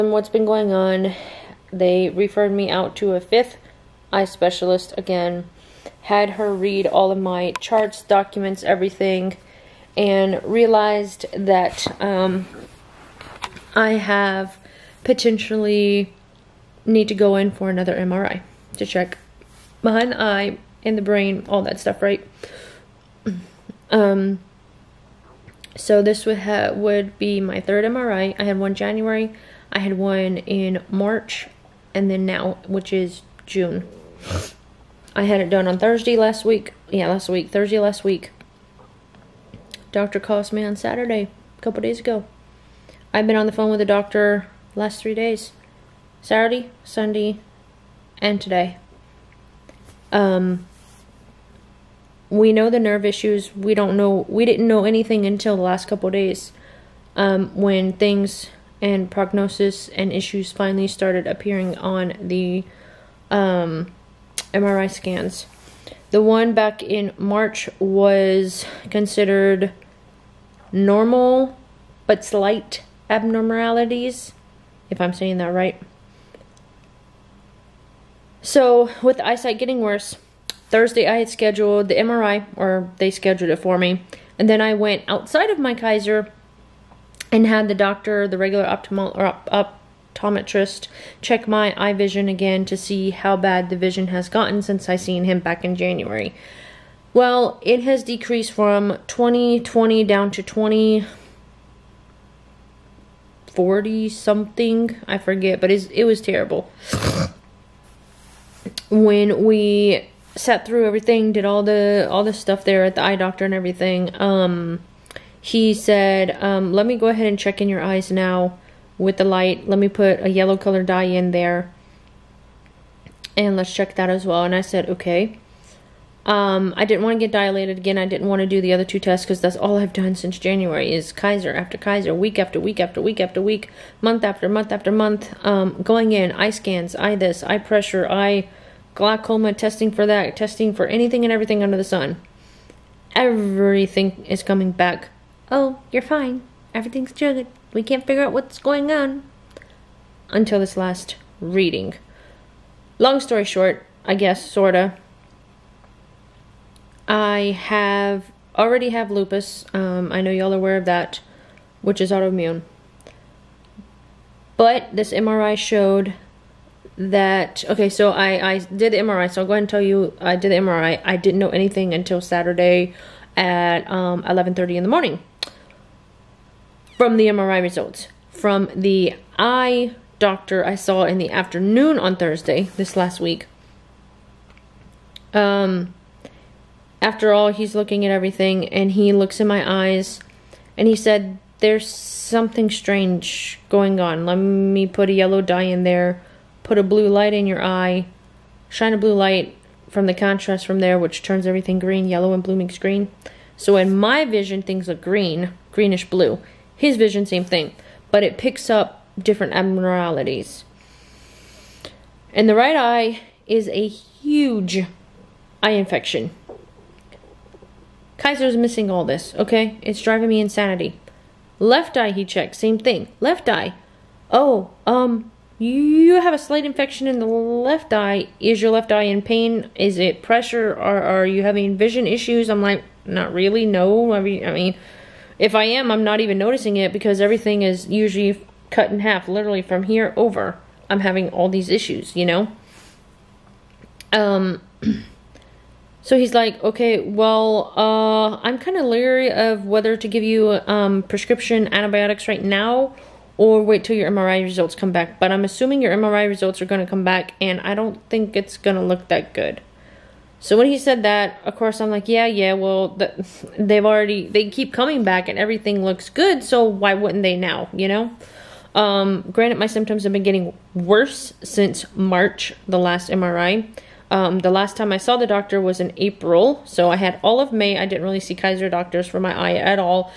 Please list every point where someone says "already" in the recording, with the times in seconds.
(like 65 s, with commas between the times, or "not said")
158 s, 263 s.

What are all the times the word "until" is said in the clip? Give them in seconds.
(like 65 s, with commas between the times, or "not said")
55 s, 150 s, 171 s.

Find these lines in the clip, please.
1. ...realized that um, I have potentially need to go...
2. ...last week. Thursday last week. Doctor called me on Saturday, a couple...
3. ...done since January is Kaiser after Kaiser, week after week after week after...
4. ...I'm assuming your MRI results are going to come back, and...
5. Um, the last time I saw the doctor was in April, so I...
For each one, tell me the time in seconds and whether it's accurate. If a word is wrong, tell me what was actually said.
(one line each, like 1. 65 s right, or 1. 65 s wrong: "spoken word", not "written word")
1. 10 s right
2. 37 s right
3. 129 s right
4. 255 s right
5. 274 s right.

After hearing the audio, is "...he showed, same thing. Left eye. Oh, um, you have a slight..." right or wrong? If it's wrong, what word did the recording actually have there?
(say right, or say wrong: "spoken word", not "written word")
wrong: "checked", not "showed".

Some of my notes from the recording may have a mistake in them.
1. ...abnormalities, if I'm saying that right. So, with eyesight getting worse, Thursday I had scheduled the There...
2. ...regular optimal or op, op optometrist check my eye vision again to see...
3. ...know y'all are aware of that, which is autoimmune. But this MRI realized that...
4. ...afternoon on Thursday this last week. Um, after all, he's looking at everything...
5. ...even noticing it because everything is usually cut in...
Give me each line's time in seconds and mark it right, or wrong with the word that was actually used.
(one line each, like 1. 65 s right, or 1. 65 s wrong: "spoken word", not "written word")
1. 73 s wrong: "MRI", not "There"
2. 88 s right
3. 160 s wrong: "showed", not "realized"
4. 181 s right
5. 236 s right.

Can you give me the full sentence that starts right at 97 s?
Well, it has decreased from 20 20 down to 20 40 something, I forget, but it was terrible.